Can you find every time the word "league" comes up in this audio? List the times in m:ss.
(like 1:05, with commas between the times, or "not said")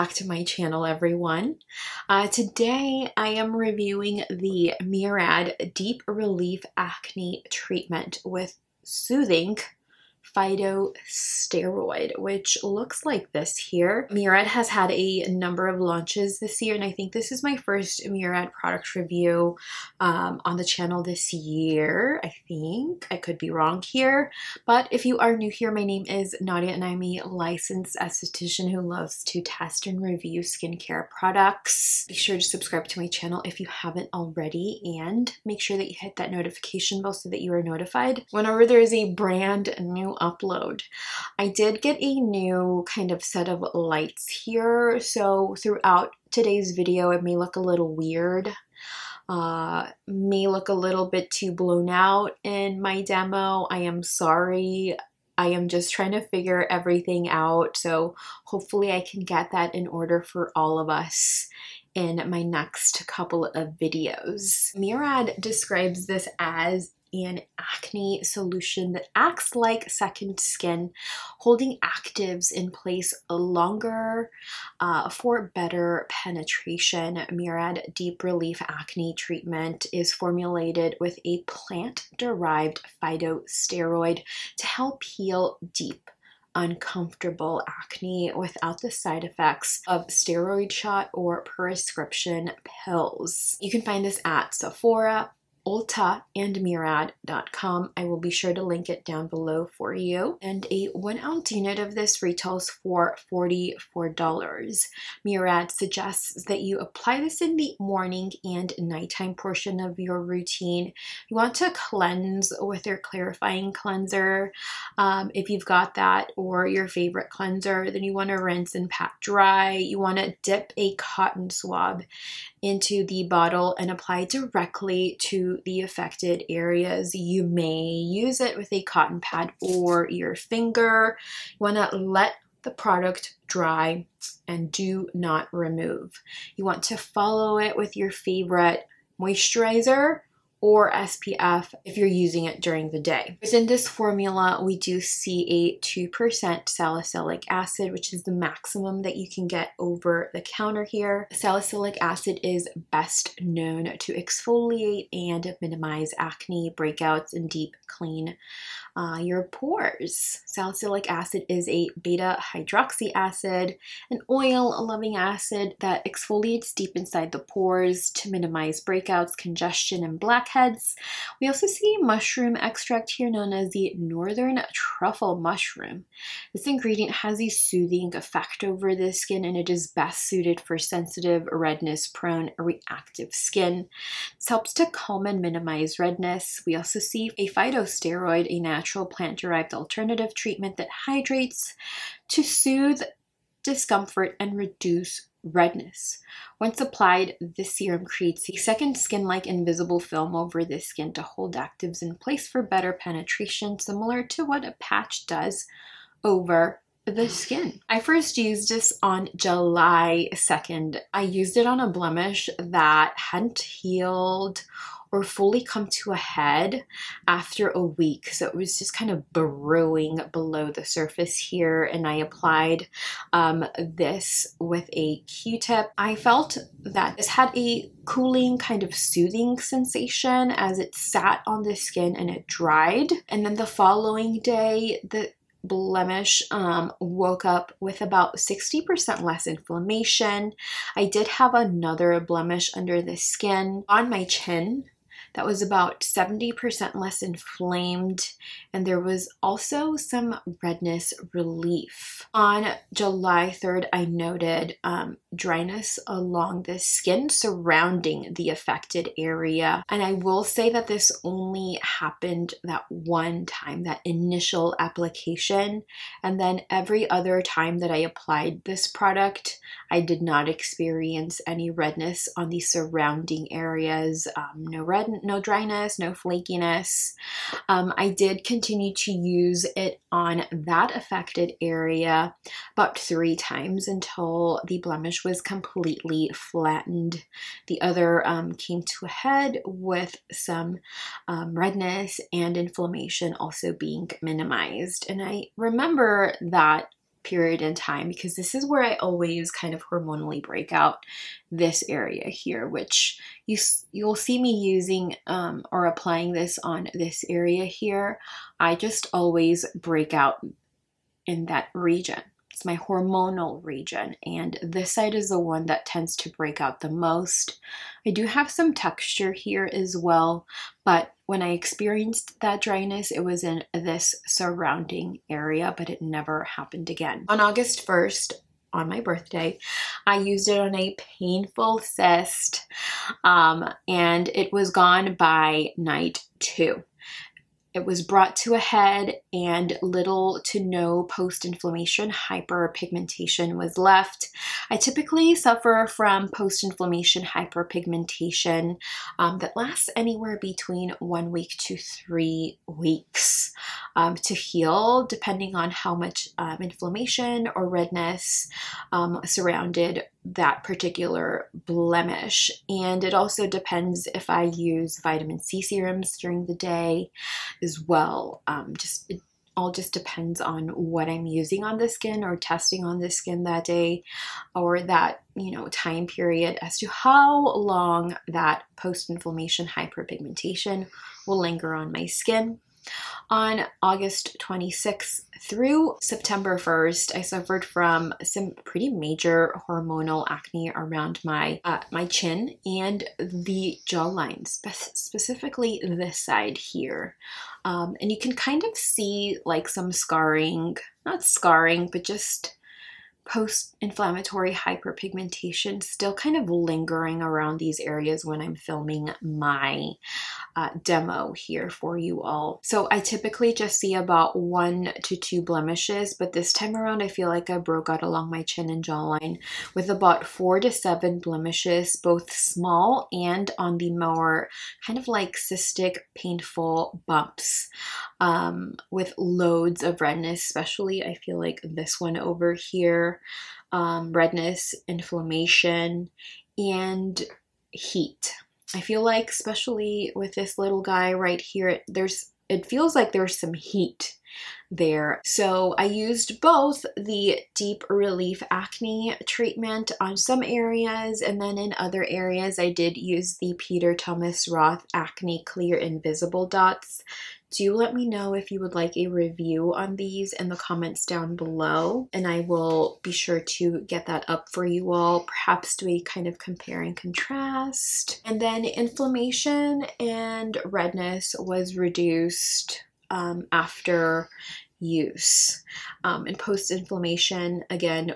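not said.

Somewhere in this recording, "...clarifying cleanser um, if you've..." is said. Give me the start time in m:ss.
1:52.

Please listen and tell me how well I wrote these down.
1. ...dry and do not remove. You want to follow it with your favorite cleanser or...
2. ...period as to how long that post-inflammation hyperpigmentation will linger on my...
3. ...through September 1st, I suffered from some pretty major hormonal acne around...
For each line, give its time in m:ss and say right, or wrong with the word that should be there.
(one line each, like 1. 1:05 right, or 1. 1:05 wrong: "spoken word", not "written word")
1. 2:13 wrong: "moisturizer", not "cleanser"
2. 6:16 right
3. 6:25 right.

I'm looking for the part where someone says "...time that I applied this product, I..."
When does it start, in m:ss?
4:27.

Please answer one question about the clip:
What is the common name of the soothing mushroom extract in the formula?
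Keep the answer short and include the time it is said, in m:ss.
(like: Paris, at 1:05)
northern truffle mushroom, at 2:53.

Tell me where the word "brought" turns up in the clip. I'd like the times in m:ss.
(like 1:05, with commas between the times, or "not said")
5:38.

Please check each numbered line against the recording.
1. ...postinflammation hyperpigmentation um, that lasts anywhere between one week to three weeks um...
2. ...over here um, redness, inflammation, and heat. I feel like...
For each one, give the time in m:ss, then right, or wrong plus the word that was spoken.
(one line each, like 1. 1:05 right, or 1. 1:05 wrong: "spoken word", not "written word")
1. 5:46 wrong: "inflammation", not "postinflammation"
2. 7:12 right.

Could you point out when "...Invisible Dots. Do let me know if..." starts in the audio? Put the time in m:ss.
7:35.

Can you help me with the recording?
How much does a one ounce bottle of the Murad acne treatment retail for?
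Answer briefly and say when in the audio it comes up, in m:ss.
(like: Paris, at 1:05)
$44, at 1:43.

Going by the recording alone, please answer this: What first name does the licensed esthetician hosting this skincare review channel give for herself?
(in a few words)
Nadia.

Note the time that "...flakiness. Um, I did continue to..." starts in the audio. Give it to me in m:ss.
4:36.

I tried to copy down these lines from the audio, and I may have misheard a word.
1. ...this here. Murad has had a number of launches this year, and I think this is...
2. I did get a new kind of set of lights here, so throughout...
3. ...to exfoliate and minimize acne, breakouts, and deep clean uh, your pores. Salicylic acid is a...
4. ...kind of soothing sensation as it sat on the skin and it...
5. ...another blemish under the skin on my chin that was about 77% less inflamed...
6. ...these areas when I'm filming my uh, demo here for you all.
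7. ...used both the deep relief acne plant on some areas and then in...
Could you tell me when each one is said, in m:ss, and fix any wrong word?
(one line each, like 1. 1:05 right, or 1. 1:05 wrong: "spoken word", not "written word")
1. 0:13 right
2. 0:41 right
3. 2:33 right
4. 3:48 right
5. 4:01 wrong: "70", not "77"
6. 6:47 right
7. 7:25 wrong: "treatment", not "plant".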